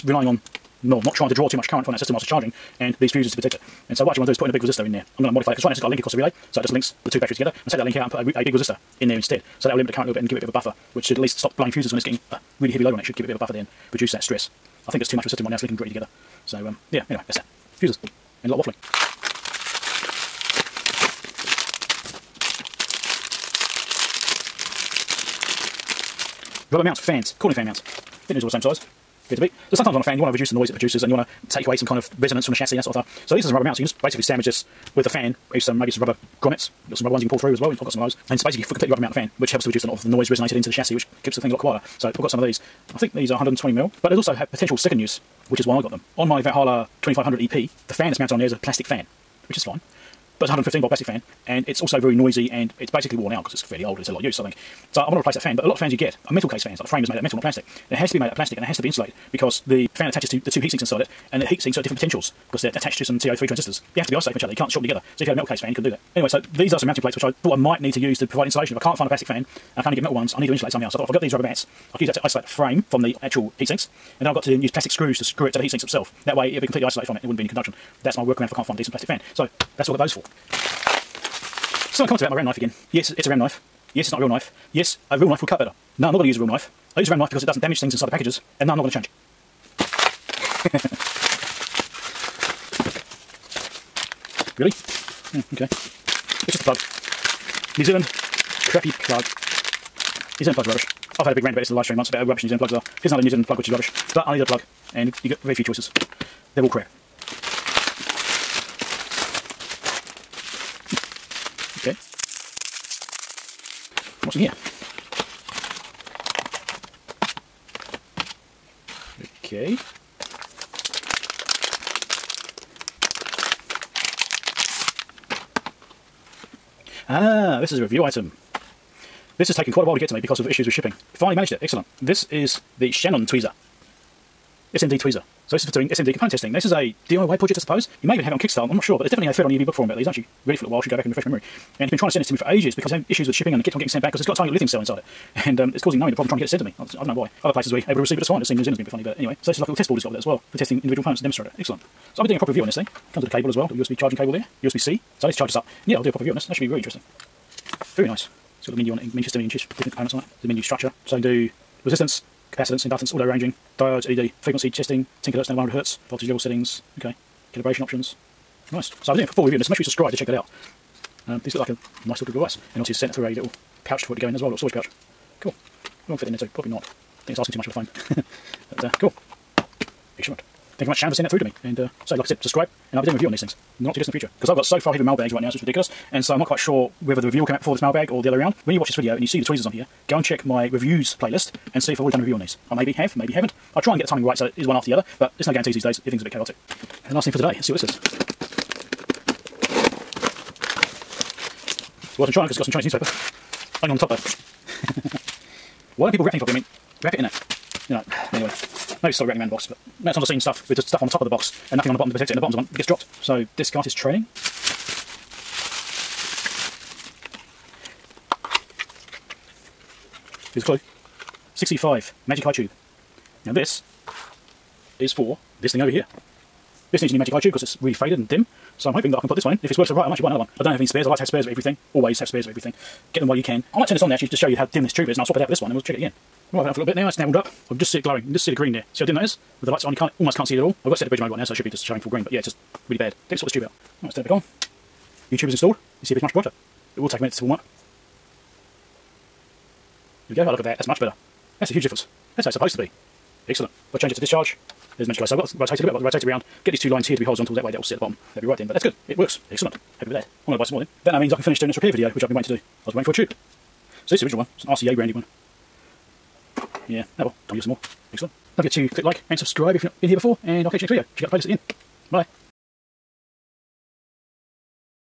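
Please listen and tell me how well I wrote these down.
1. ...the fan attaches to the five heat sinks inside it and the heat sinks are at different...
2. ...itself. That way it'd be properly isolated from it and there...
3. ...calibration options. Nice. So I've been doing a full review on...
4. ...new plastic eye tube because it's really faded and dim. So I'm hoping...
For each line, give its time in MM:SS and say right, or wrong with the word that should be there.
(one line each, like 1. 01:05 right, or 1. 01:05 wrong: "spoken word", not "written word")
1. 00:59 wrong: "two", not "five"
2. 01:15 wrong: "completely", not "properly"
3. 02:47 right
4. 03:47 wrong: "magic", not "plastic".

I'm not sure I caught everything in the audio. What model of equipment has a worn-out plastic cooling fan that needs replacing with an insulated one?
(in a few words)
Valhalla 2500 EP.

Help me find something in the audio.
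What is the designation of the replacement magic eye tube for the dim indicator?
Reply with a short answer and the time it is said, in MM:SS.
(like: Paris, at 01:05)
6E5, at 03:41.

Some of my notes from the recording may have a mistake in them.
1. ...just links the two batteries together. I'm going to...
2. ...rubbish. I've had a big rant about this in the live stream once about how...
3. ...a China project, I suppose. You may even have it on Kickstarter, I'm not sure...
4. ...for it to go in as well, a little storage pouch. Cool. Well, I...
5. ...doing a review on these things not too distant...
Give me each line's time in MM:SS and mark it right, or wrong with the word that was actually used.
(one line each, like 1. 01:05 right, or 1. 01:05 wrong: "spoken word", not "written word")
1. 00:06 right
2. 01:40 right
3. 02:16 wrong: "DIY", not "China"
4. 02:54 right
5. 03:03 right.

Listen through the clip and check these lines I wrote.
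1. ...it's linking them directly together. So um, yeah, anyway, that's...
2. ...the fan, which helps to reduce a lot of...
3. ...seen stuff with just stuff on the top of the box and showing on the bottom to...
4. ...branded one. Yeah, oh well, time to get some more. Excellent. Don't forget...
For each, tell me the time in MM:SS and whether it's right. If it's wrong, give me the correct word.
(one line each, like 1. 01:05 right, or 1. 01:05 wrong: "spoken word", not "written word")
1. 00:15 right
2. 00:39 right
3. 03:30 wrong: "nothing", not "showing"
4. 04:24 right.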